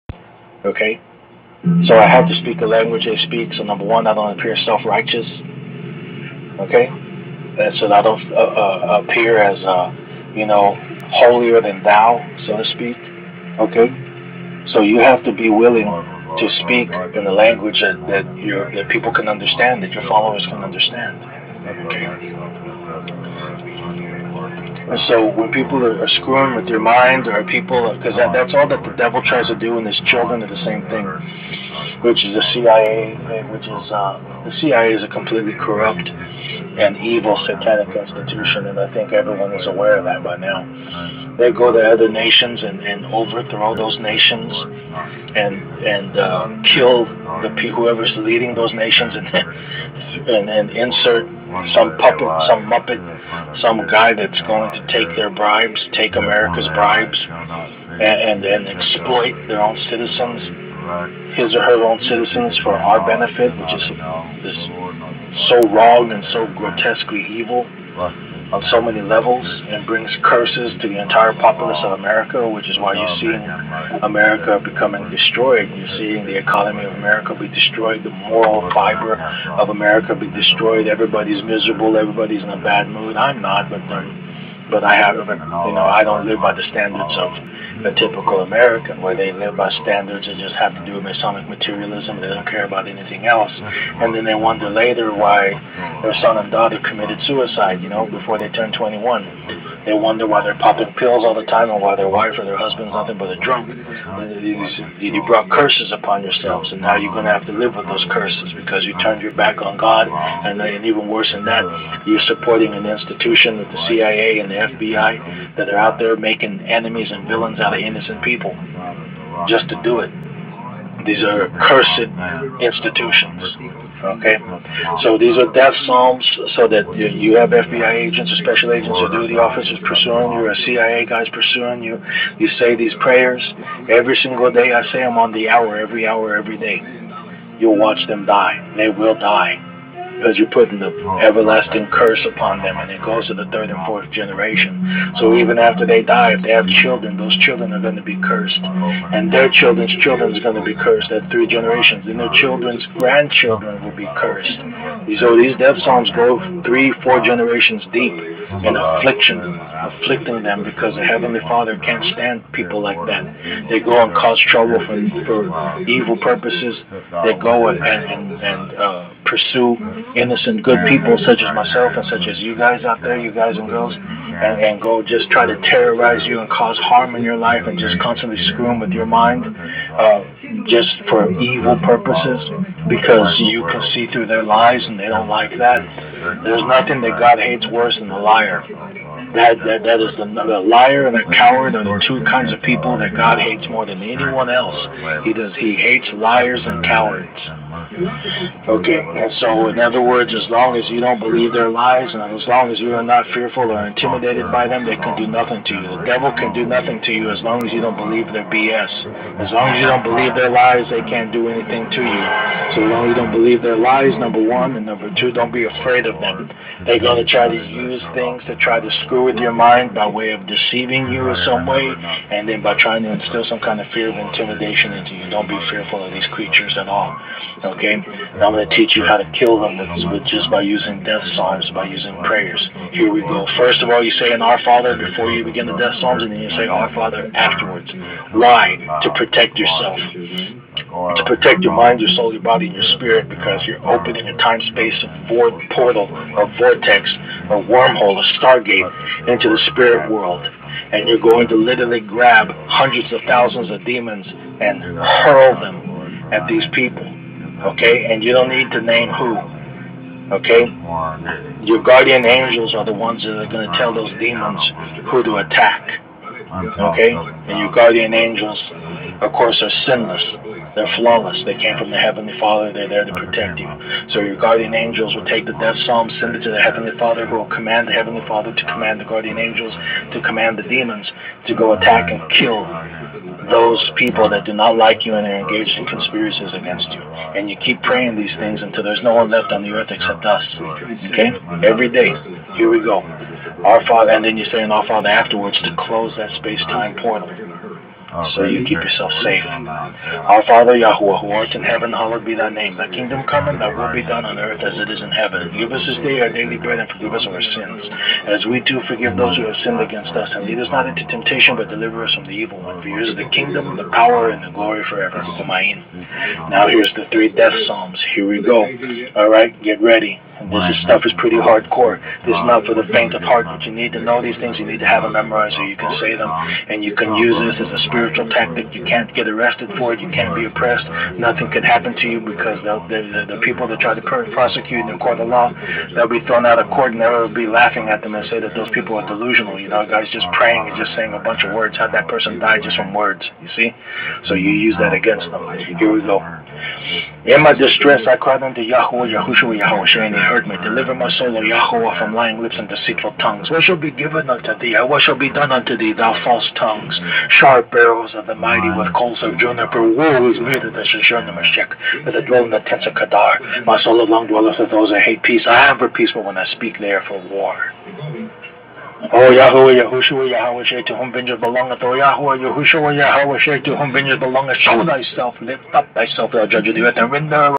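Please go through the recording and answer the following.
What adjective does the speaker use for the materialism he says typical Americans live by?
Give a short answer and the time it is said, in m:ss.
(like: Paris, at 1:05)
Masonic, at 1:31.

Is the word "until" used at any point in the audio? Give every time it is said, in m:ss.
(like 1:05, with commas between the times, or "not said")
4:48.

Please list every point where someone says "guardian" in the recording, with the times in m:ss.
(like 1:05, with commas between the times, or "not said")
4:21, 4:27, 4:34, 4:39.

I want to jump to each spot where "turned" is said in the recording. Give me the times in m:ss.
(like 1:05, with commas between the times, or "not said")
1:38, 1:48.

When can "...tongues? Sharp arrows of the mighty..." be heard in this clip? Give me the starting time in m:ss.
5:56.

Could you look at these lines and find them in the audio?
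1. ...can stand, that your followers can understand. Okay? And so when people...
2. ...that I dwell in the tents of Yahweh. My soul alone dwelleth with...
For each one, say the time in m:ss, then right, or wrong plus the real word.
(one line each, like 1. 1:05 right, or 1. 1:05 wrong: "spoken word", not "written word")
1. 0:19 wrong: "understand", not "stand"
2. 6:02 wrong: "Kedar", not "Yahweh".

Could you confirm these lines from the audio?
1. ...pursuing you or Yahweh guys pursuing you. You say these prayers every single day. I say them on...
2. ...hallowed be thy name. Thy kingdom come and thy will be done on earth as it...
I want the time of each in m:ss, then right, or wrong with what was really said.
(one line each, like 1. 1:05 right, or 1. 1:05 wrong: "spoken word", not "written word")
1. 2:09 wrong: "CIA", not "Yahweh"
2. 5:01 right.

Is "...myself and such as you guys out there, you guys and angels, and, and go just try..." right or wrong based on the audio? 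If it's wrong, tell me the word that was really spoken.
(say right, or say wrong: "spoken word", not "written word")
wrong: "girls", not "angels".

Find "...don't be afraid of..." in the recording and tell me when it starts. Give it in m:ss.
3:35.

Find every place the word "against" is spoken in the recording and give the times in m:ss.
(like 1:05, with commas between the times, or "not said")
4:46, 5:09, 5:44.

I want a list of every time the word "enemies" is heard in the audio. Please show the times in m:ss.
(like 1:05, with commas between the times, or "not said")
1:56.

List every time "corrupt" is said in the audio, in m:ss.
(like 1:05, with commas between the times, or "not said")
0:35.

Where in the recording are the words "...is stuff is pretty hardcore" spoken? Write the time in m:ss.
5:20.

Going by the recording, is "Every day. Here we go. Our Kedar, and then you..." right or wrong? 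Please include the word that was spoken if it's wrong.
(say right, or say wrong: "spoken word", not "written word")
wrong: "Father", not "Kedar".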